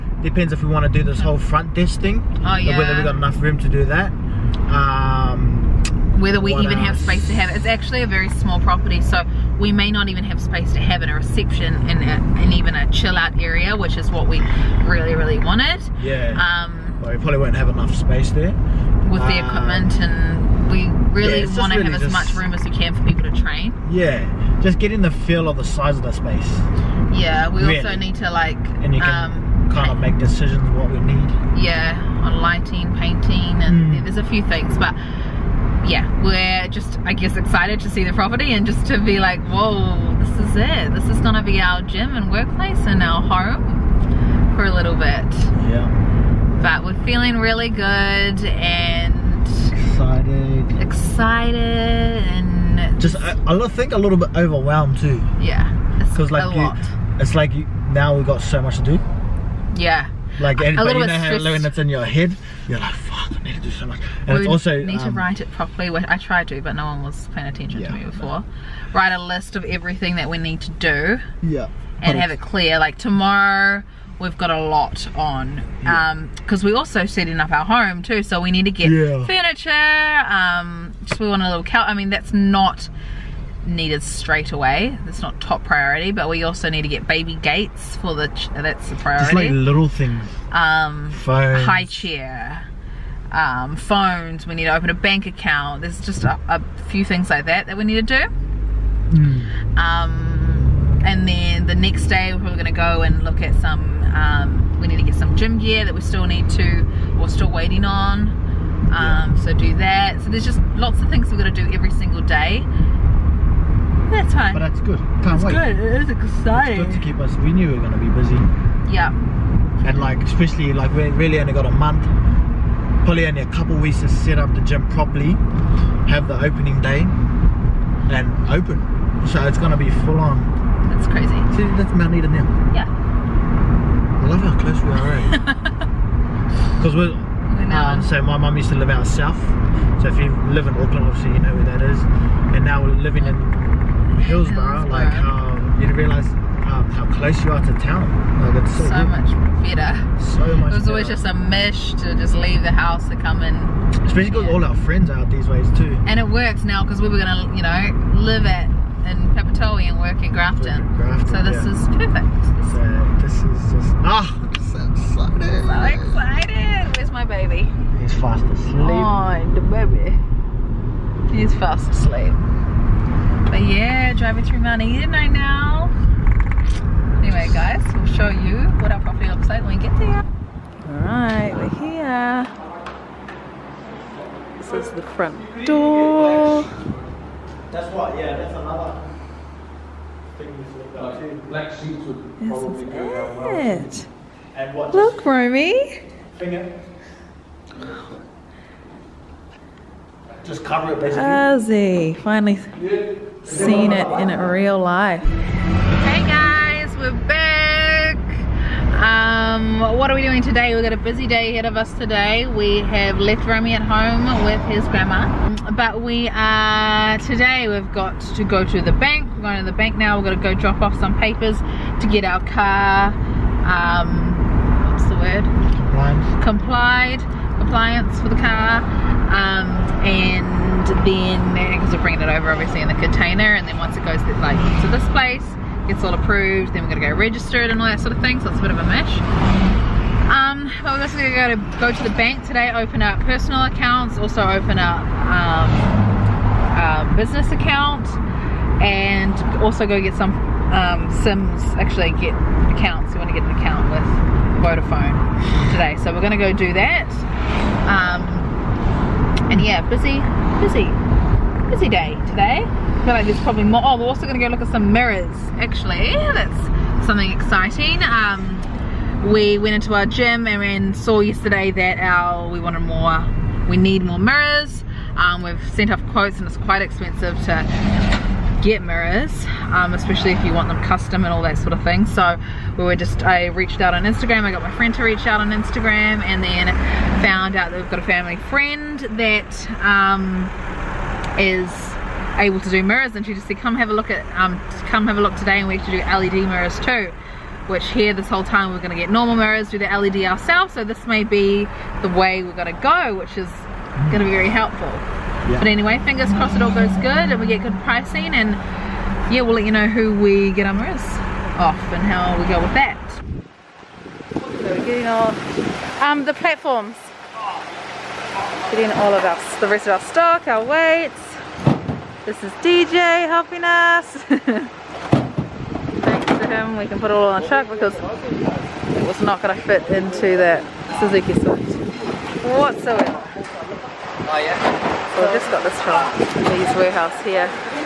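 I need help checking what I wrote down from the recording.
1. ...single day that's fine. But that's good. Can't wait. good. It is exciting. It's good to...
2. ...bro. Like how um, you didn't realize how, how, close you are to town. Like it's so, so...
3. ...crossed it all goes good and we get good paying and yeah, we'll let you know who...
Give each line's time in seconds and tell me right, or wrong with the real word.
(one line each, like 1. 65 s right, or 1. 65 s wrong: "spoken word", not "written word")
1. 111 s right
2. 144 s right
3. 306 s wrong: "pricing", not "paying".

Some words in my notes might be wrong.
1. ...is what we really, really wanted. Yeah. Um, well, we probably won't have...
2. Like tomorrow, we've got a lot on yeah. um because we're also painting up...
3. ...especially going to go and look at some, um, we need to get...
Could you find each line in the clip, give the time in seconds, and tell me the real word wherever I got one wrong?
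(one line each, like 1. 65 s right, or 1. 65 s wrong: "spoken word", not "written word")
1. 13 s right
2. 72 s wrong: "setting", not "painting"
3. 102 s wrong: "probably", not "especially".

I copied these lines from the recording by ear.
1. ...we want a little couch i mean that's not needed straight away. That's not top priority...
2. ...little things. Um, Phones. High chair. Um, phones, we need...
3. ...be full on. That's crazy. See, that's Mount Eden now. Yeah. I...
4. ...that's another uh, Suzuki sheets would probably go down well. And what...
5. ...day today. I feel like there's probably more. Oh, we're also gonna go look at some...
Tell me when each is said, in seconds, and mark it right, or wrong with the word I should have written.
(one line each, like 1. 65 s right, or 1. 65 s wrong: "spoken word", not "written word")
1. 81 s right
2. 89 s right
3. 129 s right
4. 188 s wrong: "Black", not "Suzuki"
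5. 261 s right.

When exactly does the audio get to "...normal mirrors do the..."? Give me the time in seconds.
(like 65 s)
299 s.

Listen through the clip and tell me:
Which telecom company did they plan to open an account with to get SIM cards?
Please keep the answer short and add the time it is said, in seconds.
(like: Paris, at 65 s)
Vodafone, at 254 s.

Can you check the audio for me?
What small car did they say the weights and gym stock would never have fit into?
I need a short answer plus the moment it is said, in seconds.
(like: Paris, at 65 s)
Suzuki Swift, at 331 s.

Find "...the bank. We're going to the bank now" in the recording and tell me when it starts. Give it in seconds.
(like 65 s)
218 s.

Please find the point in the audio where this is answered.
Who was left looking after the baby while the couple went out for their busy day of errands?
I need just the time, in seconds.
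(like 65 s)
214 s.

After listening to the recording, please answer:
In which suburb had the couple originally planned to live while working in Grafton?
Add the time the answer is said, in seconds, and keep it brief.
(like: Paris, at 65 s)
Papatoe, at 159 s.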